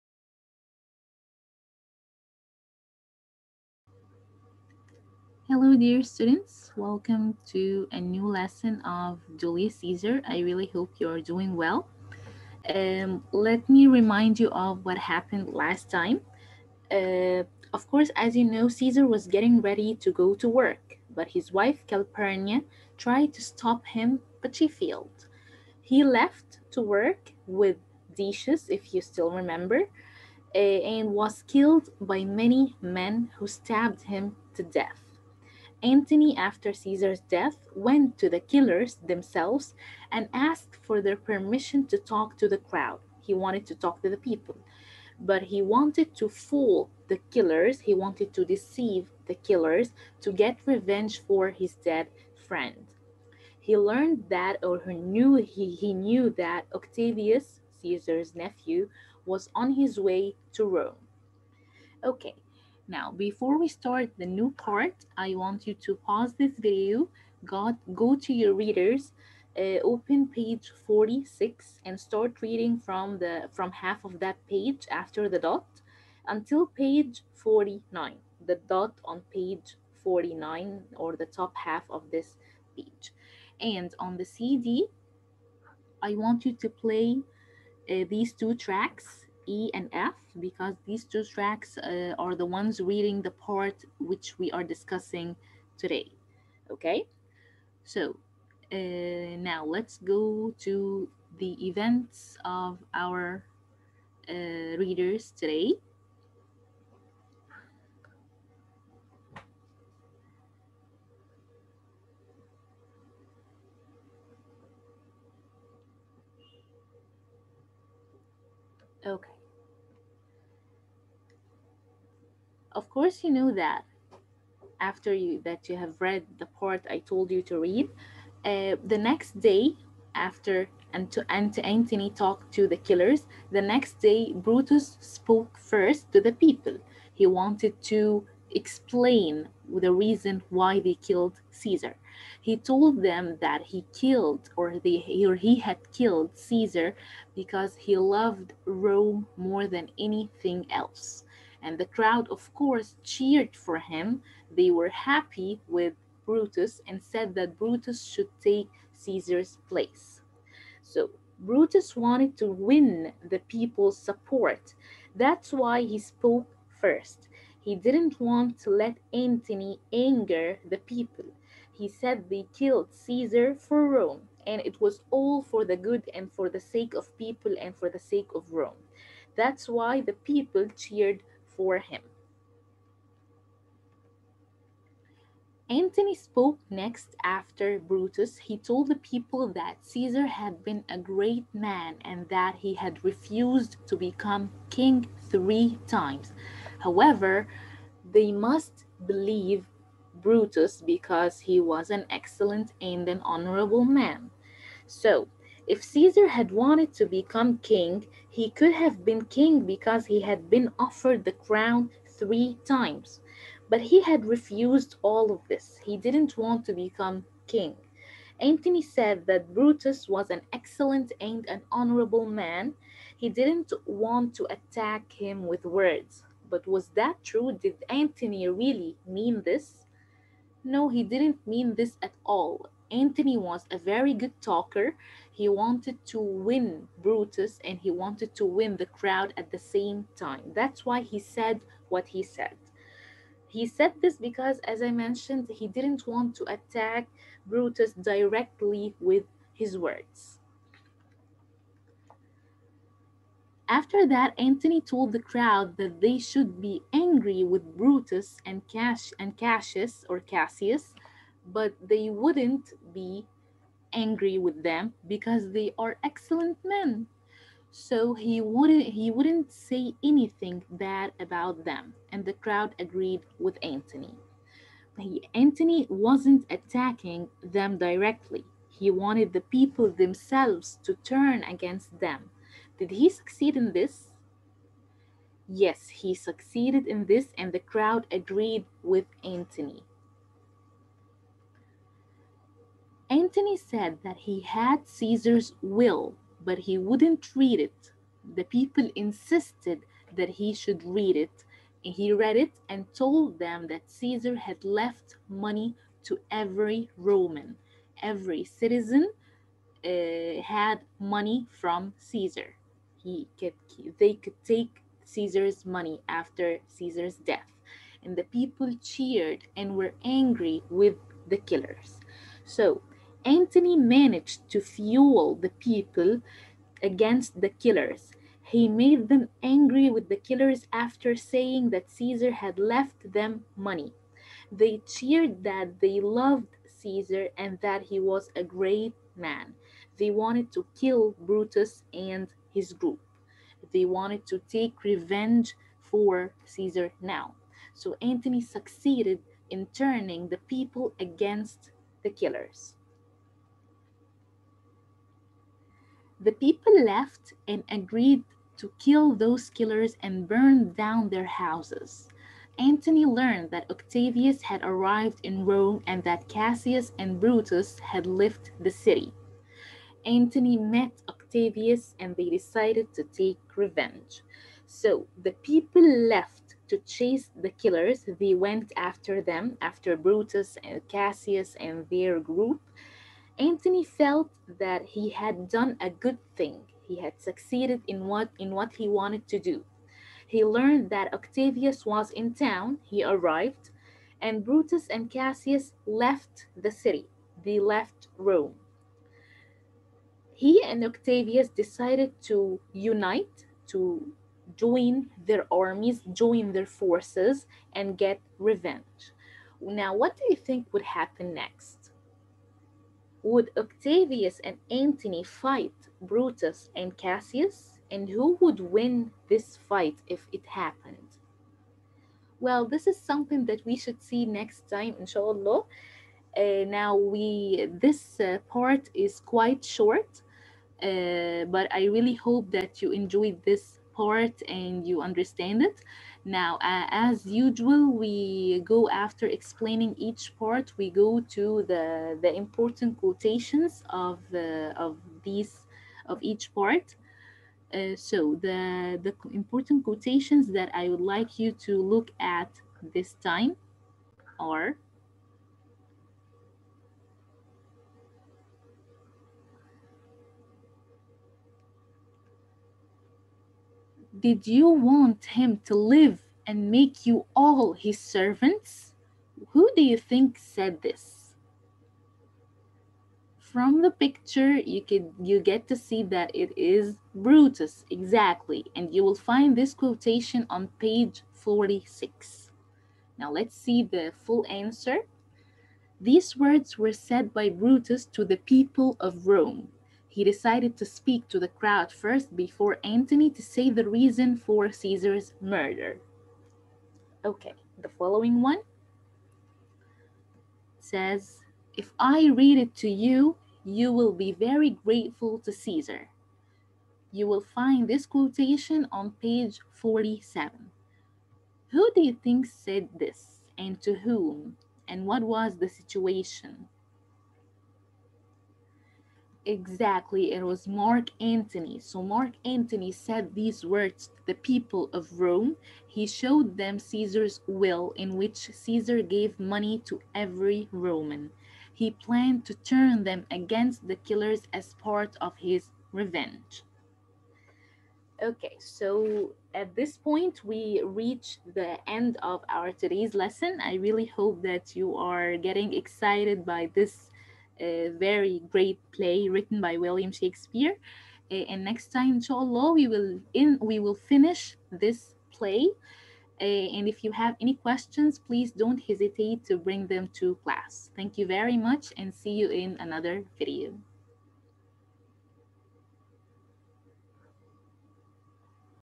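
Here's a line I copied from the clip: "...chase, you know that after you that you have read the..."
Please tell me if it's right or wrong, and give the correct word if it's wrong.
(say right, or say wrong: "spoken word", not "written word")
wrong: "course", not "chase".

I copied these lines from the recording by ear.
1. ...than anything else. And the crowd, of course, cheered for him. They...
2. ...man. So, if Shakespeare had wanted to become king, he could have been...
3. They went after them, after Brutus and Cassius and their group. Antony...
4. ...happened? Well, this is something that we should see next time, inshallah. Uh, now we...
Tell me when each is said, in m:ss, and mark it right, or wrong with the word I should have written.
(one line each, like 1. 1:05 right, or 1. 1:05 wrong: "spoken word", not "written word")
1. 2:29 right
2. 3:23 wrong: "Caesar", not "Shakespeare"
3. 6:18 right
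4. 7:00 right.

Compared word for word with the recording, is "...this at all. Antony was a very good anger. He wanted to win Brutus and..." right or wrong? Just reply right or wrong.
wrong.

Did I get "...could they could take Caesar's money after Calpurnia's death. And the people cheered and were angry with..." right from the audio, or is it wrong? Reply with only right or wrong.
wrong.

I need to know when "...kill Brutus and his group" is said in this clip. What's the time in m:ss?
5:40.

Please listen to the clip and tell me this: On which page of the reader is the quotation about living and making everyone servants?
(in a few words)
46.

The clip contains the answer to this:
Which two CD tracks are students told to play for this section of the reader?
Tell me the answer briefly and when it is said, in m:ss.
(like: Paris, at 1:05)
E and F, at 1:28.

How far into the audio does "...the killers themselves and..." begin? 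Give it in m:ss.
0:38.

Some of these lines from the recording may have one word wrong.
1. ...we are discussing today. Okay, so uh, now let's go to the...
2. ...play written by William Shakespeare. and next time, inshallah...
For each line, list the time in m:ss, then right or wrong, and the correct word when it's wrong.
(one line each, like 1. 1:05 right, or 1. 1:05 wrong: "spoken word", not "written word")
1. 1:34 right
2. 9:08 right.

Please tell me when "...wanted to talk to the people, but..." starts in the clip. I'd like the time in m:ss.
0:43.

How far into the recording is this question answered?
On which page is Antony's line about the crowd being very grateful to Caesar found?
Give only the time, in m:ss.
8:28.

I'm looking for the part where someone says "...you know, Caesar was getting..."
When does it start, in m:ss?
0:18.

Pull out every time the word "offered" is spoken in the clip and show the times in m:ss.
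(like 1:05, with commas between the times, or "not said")
3:30.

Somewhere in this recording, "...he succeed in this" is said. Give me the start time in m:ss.
4:42.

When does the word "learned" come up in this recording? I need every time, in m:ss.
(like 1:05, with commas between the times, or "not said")
0:53, 6:03, 6:30.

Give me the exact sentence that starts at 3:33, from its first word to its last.
But he had refused all of this.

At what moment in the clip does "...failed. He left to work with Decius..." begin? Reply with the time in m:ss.
0:24.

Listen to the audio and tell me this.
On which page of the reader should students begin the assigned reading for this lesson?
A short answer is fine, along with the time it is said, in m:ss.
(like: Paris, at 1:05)
46, at 1:09.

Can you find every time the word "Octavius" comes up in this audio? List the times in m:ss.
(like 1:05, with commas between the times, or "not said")
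0:56, 6:03, 6:11, 6:31, 6:40, 6:53.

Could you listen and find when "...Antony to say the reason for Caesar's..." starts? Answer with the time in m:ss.
8:12.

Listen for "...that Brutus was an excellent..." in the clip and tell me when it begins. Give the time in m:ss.
3:39.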